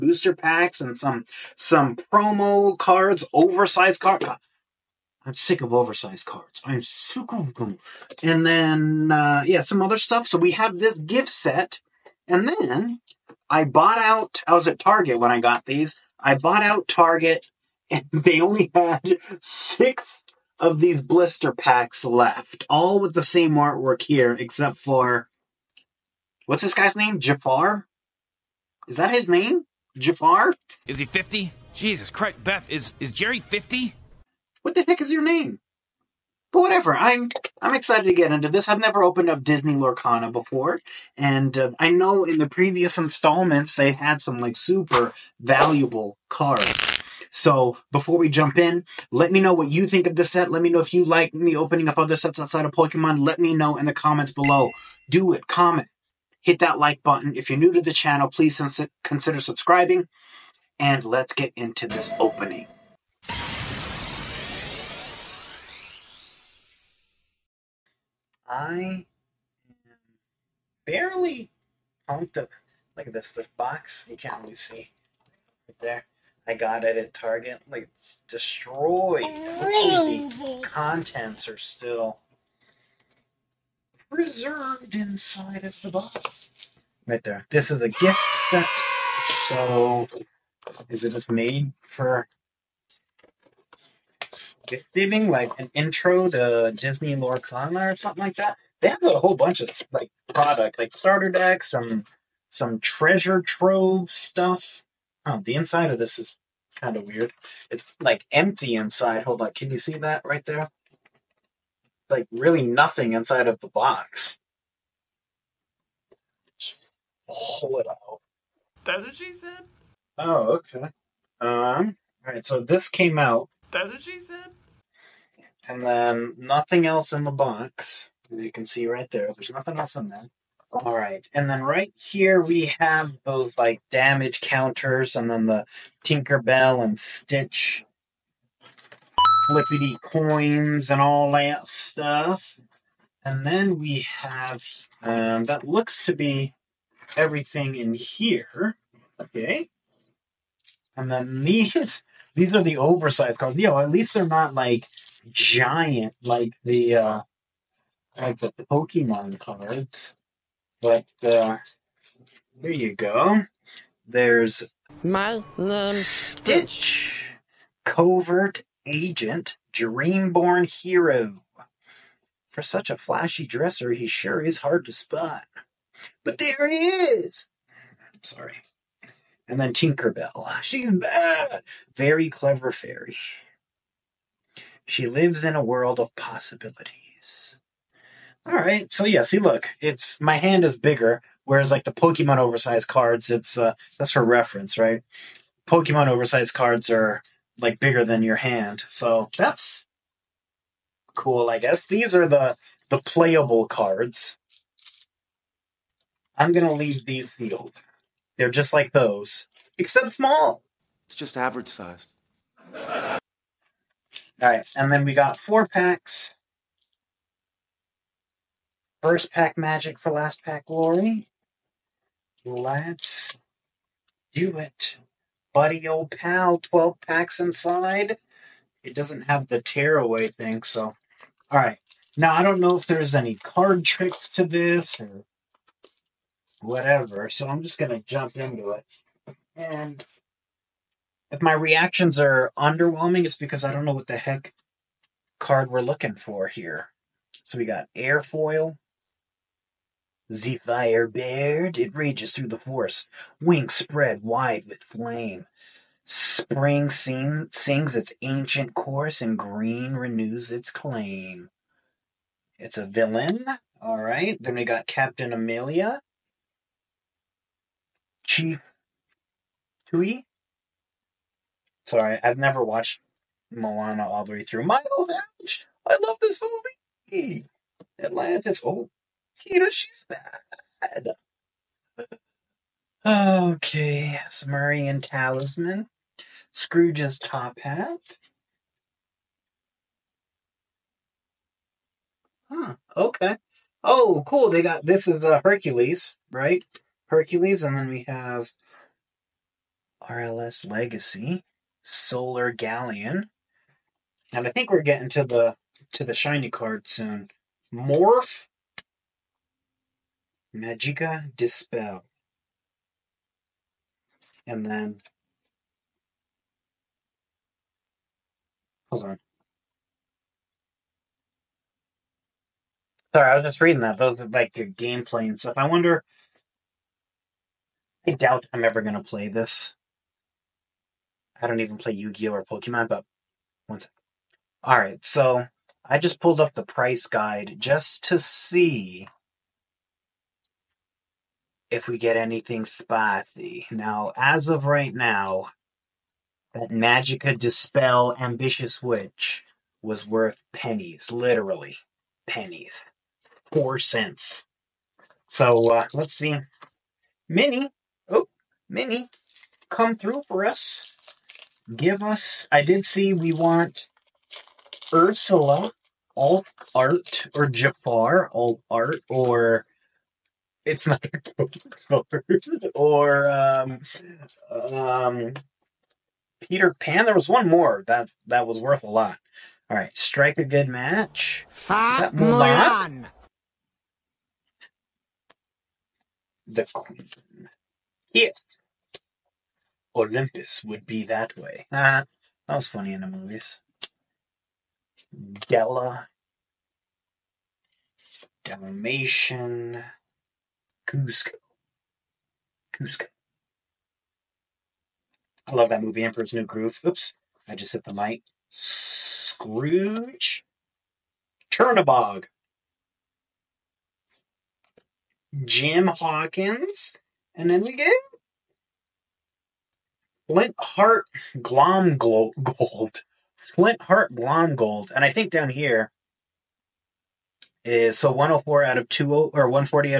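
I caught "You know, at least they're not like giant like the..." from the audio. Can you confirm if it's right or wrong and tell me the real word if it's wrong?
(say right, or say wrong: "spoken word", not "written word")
right.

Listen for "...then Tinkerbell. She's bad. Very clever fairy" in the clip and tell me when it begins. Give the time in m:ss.
2:59.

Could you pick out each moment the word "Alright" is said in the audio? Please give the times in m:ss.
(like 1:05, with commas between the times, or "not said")
3:51, 5:34.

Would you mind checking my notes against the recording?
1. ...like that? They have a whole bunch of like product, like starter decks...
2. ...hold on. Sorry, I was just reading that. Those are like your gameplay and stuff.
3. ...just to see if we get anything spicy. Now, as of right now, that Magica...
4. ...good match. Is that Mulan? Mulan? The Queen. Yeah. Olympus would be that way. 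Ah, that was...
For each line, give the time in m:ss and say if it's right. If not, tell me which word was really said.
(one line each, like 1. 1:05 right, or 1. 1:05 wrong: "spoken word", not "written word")
1. 1:38 right
2. 5:18 right
3. 5:37 right
4. 6:20 right.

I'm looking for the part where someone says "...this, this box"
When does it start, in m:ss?
1:13.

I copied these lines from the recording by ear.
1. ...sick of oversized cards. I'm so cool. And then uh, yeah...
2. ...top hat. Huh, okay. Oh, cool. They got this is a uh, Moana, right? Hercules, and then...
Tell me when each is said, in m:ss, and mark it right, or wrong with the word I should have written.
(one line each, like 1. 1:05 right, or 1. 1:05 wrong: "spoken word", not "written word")
1. 0:05 right
2. 4:47 wrong: "Hercules", not "Moana".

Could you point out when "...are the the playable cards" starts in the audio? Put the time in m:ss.
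3:22.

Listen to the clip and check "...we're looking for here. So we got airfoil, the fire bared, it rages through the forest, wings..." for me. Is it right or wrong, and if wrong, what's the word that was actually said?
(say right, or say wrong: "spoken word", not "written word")
right.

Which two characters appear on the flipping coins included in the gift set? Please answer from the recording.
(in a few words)
Tinkerbell and Stitch.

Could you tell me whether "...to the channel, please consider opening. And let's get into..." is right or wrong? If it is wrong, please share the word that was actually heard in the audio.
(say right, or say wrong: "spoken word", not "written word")
wrong: "subscribing", not "opening".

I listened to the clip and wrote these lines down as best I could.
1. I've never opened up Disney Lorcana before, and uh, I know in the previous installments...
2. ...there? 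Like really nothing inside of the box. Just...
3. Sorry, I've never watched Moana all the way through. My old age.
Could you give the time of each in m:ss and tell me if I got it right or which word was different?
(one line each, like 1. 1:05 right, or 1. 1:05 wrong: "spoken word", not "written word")
1. 0:38 right
2. 1:50 right
3. 4:31 right.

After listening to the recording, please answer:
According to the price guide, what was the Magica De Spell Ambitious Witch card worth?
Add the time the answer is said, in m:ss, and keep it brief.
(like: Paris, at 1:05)
4 cents, at 5:53.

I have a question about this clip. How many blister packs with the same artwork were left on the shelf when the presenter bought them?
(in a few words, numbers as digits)
6.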